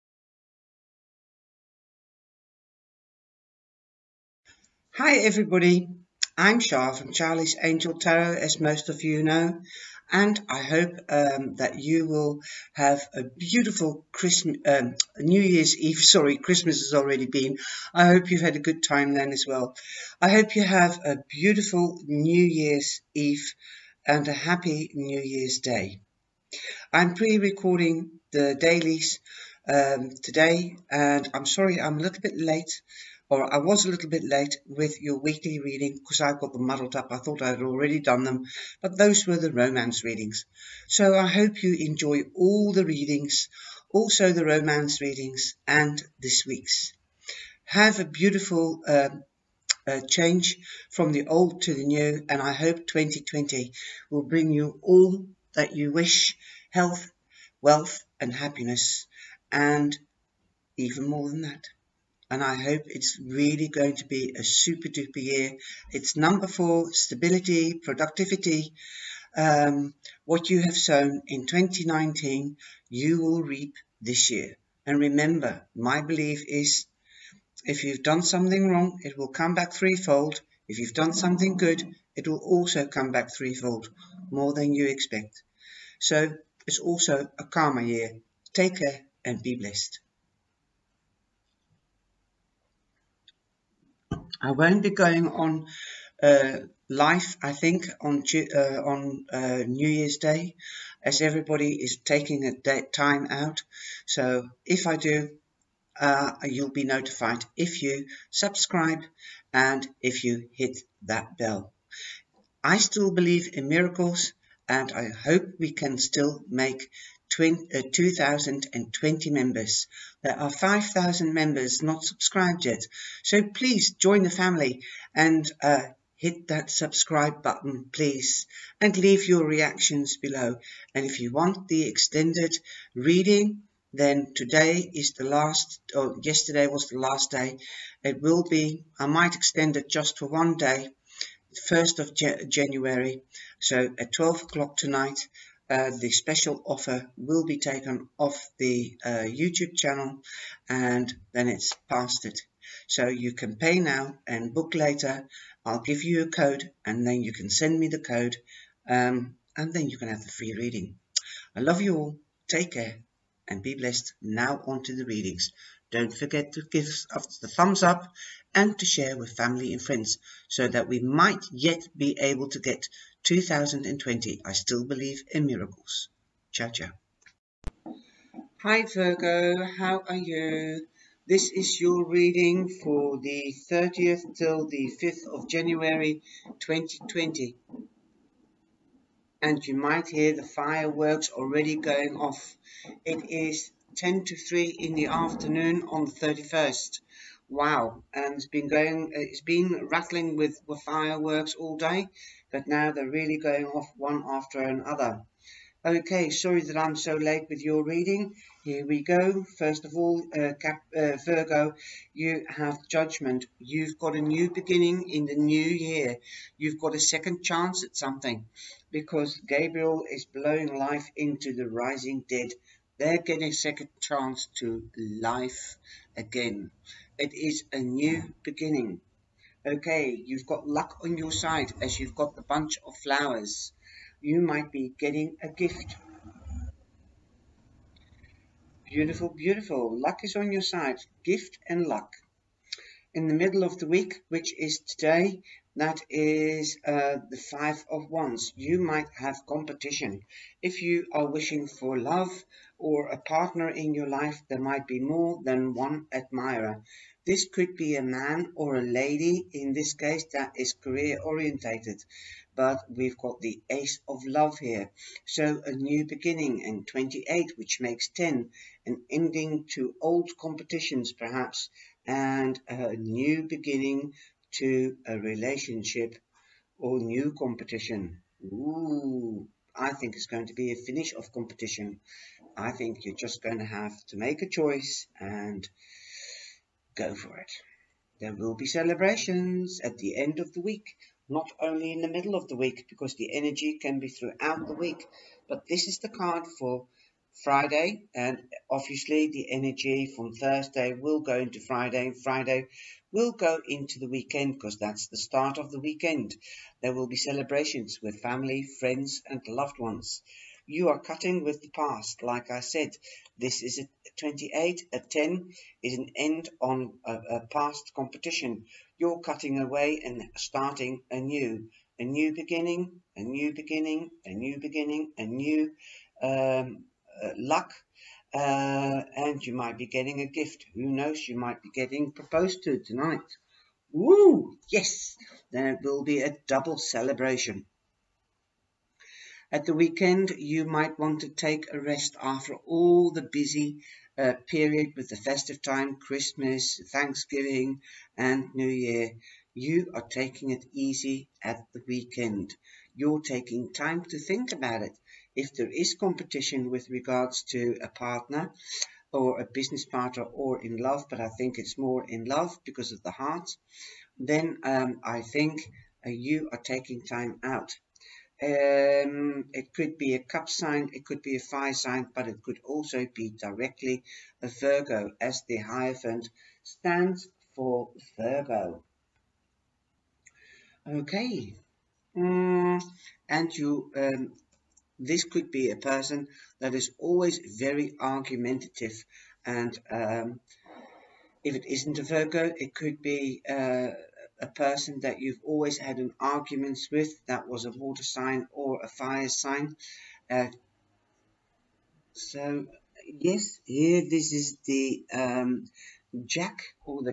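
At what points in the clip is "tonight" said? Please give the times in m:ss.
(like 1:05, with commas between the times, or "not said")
2:24, 5:32.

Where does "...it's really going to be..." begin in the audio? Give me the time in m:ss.
1:02.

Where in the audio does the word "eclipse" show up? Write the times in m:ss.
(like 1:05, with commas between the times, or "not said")
not said.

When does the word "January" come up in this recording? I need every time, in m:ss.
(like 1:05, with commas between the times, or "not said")
2:22, 3:05.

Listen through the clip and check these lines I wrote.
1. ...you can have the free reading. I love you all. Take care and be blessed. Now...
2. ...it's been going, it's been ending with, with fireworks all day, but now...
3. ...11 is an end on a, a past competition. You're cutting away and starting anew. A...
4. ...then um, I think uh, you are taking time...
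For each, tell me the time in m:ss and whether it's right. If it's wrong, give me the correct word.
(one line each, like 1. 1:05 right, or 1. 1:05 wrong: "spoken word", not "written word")
1. 2:39 right
2. 3:18 wrong: "rattling", not "ending"
3. 5:14 wrong: "10", not "11"
4. 6:04 right.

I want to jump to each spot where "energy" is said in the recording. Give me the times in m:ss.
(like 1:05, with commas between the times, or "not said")
4:53, 4:59.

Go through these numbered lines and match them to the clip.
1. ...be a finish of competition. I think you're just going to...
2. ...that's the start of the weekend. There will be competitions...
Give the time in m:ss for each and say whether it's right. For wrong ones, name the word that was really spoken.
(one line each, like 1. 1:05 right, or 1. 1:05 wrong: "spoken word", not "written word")
1. 4:40 right
2. 5:04 wrong: "celebrations", not "competitions".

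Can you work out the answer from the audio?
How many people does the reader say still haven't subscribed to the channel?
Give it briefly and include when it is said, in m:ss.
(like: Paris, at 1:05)
5,000, at 2:00.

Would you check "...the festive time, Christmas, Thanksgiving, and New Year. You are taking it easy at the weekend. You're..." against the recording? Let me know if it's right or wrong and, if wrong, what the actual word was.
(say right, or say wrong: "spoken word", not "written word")
right.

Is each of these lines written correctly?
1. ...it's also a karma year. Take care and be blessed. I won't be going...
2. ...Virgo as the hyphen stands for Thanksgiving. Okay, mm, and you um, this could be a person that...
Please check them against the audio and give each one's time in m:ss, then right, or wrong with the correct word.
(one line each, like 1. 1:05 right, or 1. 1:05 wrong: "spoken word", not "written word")
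1. 1:26 right
2. 6:14 wrong: "Virgo", not "Thanksgiving".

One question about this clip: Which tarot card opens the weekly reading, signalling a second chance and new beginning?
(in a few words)
Judgment.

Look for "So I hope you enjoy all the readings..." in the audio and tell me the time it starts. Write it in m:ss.
0:40.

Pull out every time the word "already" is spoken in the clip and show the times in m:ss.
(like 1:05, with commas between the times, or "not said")
0:16, 0:37, 3:11.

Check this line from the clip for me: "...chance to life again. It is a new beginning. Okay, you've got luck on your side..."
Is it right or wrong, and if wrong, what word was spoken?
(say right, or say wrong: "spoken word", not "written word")
right.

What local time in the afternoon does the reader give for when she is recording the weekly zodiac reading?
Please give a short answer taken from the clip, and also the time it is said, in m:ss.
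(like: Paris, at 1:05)
10 to 3, at 3:13.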